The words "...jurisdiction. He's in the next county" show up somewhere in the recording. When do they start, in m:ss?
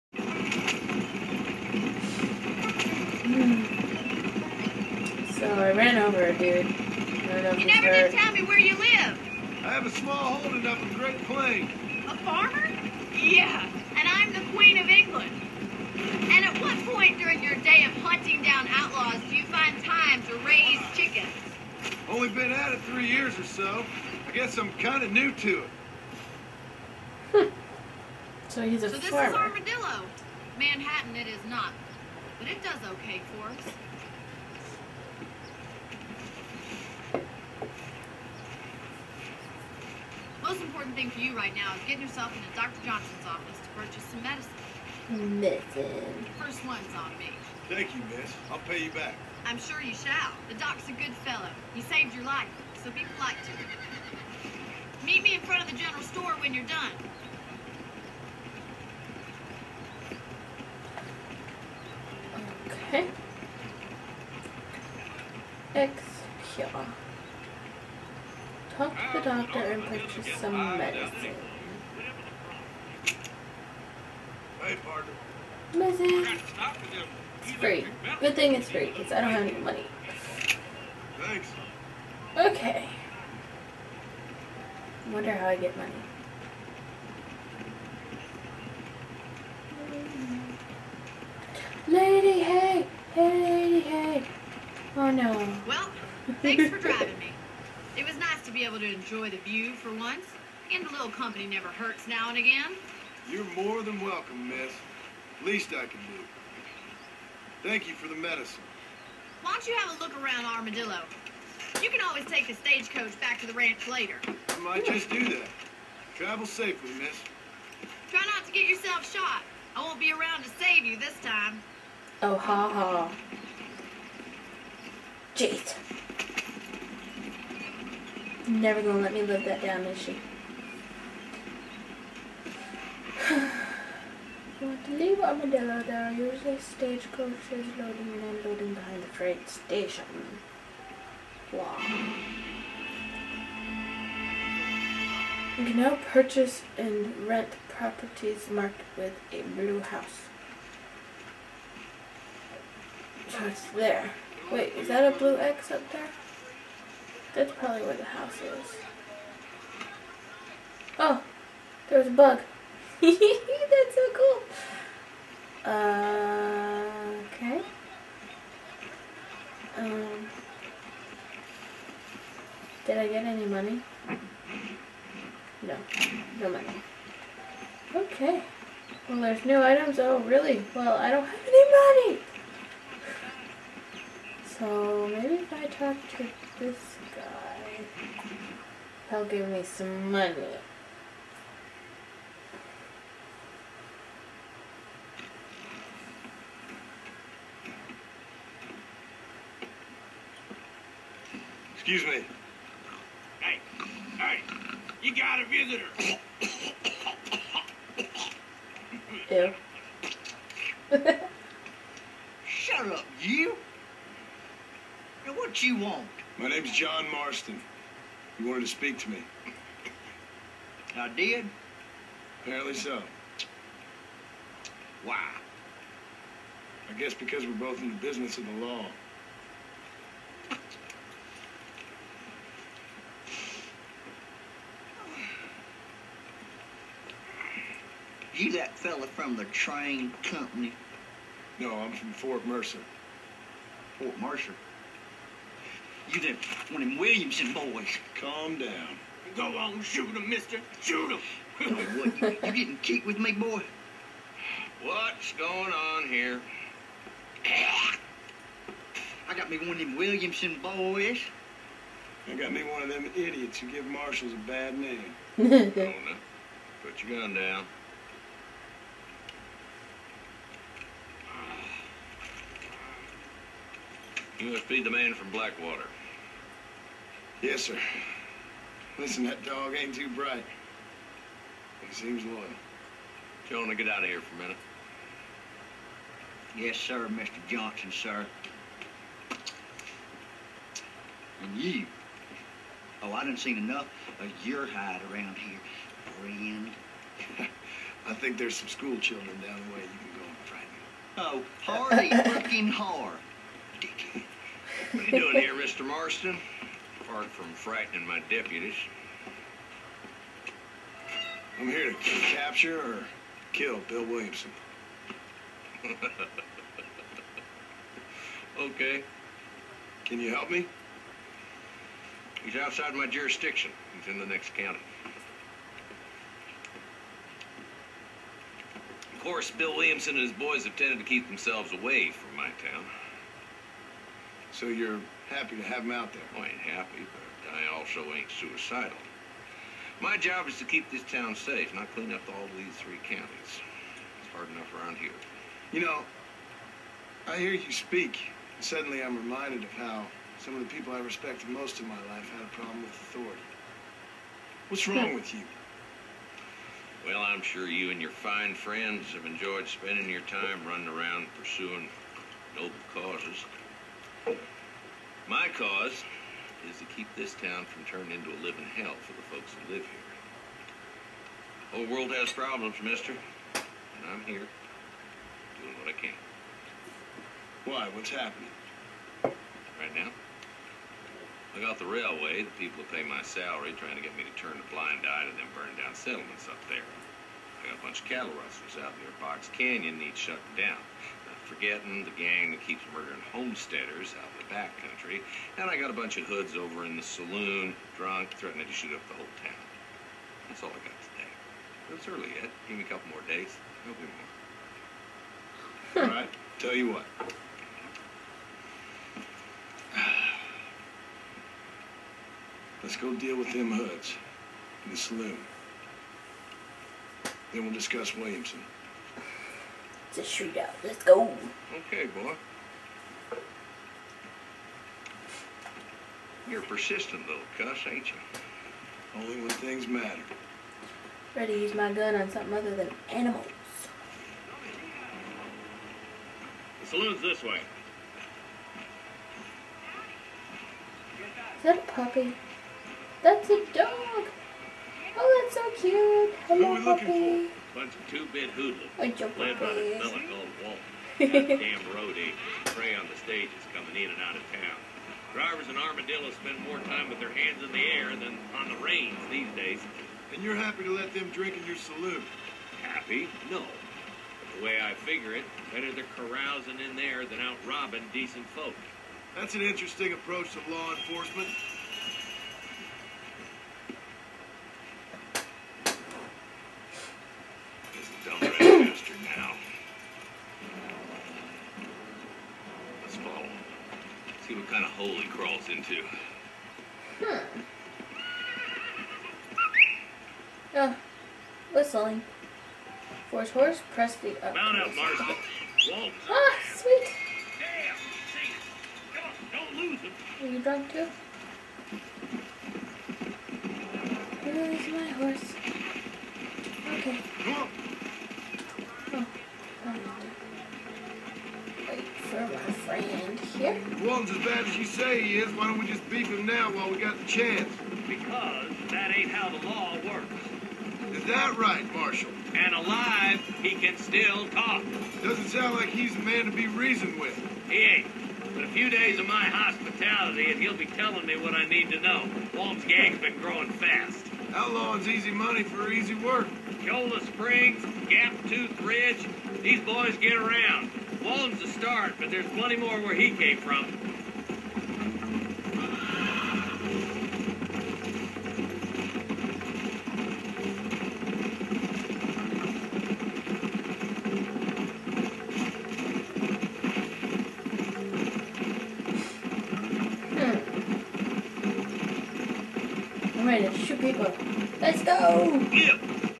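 5:23.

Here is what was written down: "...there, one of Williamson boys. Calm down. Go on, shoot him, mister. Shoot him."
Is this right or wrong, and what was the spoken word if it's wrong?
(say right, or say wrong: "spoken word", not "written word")
right.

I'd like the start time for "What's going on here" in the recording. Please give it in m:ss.
4:14.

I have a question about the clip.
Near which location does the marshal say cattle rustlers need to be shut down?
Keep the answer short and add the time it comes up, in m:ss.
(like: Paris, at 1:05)
Box Canyon, at 6:29.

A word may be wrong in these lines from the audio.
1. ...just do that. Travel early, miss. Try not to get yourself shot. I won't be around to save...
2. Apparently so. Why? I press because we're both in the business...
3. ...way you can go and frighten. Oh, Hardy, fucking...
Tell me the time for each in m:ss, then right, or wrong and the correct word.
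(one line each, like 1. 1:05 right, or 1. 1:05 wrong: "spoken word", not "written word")
1. 1:54 wrong: "safely", not "early"
2. 3:42 wrong: "guess", not "press"
3. 4:59 right.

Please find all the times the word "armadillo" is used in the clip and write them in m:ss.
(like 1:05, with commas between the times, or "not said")
0:29, 1:50, 2:15, 7:35.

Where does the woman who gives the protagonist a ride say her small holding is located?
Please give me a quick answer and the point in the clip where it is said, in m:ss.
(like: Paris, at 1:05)
Great Plain, at 0:10.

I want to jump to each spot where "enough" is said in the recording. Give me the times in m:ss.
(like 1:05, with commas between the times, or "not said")
4:53, 5:44.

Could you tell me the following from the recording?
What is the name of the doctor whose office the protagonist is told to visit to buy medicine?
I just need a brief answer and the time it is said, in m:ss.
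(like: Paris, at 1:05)
Dr. Johnson, at 0:42.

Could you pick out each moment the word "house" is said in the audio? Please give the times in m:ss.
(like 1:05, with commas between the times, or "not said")
2:29, 2:38.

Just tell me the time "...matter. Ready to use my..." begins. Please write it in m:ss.
7:09.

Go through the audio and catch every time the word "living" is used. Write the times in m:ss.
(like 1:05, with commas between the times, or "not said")
6:08.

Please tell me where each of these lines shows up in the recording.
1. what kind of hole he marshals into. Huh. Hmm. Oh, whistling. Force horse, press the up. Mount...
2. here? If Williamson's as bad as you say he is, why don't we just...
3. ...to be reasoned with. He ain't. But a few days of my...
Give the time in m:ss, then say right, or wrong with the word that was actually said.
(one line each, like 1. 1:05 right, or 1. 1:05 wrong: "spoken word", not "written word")
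1. 8:04 wrong: "crawls", not "marshals"
2. 8:33 wrong: "Walton", not "Williamson"
3. 8:46 right.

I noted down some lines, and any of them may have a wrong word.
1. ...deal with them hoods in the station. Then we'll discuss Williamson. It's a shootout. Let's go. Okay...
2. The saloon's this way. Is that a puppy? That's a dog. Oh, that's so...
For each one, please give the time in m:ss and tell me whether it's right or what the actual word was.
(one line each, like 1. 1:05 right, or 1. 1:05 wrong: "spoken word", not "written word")
1. 6:53 wrong: "saloon", not "station"
2. 7:16 right.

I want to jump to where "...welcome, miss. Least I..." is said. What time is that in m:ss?
1:44.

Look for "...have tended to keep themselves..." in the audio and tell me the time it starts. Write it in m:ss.
5:30.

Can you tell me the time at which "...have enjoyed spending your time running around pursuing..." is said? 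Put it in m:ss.
5:59.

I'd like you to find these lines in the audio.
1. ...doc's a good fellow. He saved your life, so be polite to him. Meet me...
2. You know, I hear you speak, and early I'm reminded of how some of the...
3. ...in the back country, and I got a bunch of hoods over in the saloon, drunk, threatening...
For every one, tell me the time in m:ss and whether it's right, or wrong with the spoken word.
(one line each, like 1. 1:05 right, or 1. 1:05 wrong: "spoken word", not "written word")
1. 0:50 right
2. 5:45 wrong: "suddenly", not "early"
3. 6:34 right.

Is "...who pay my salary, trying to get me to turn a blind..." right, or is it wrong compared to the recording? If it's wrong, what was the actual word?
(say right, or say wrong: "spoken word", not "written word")
right.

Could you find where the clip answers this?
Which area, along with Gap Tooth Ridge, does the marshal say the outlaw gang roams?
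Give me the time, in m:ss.
8:56.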